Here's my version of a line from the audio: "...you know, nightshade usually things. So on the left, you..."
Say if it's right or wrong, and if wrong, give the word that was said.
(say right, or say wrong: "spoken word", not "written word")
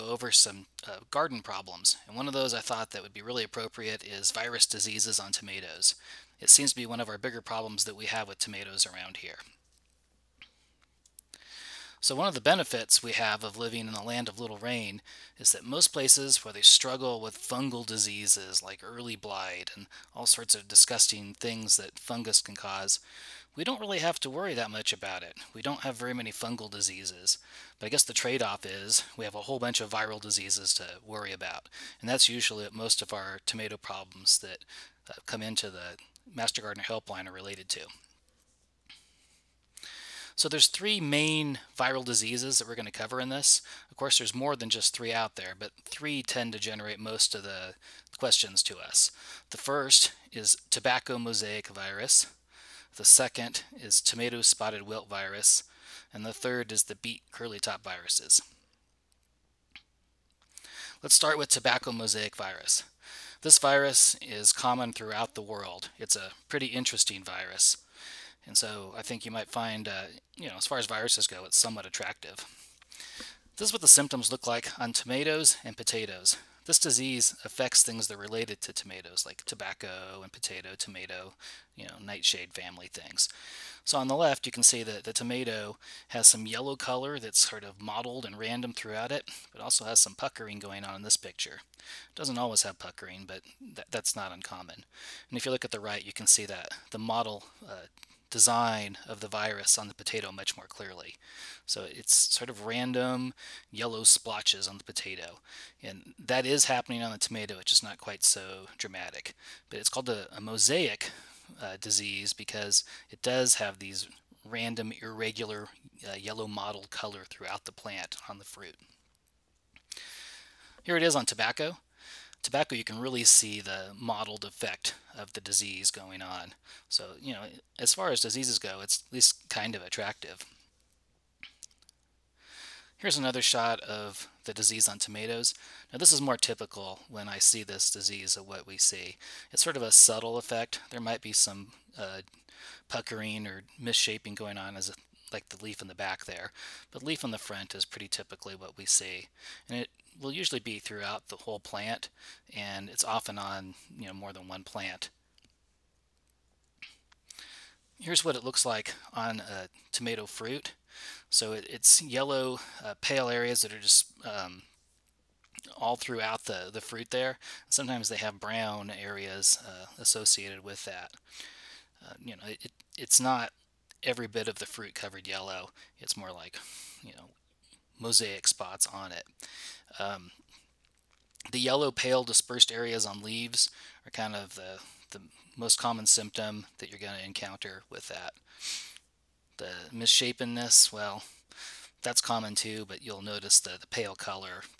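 wrong: "family", not "usually".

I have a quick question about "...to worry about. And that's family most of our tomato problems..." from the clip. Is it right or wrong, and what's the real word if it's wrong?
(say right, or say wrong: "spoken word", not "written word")
wrong: "usually", not "family".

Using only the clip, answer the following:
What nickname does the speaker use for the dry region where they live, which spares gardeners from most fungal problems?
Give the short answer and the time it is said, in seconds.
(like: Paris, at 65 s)
the land of little rain, at 14 s.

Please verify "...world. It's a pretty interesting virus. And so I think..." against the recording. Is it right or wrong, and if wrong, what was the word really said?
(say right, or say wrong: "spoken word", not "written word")
right.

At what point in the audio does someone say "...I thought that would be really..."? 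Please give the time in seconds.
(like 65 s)
2 s.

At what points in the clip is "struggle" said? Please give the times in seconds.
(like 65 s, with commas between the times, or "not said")
16 s.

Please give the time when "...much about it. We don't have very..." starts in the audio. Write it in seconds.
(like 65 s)
24 s.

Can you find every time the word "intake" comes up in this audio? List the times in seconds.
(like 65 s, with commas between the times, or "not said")
not said.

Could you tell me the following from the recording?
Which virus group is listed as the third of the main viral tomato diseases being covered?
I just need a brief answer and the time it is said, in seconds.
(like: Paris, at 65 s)
beet curly top viruses, at 56 s.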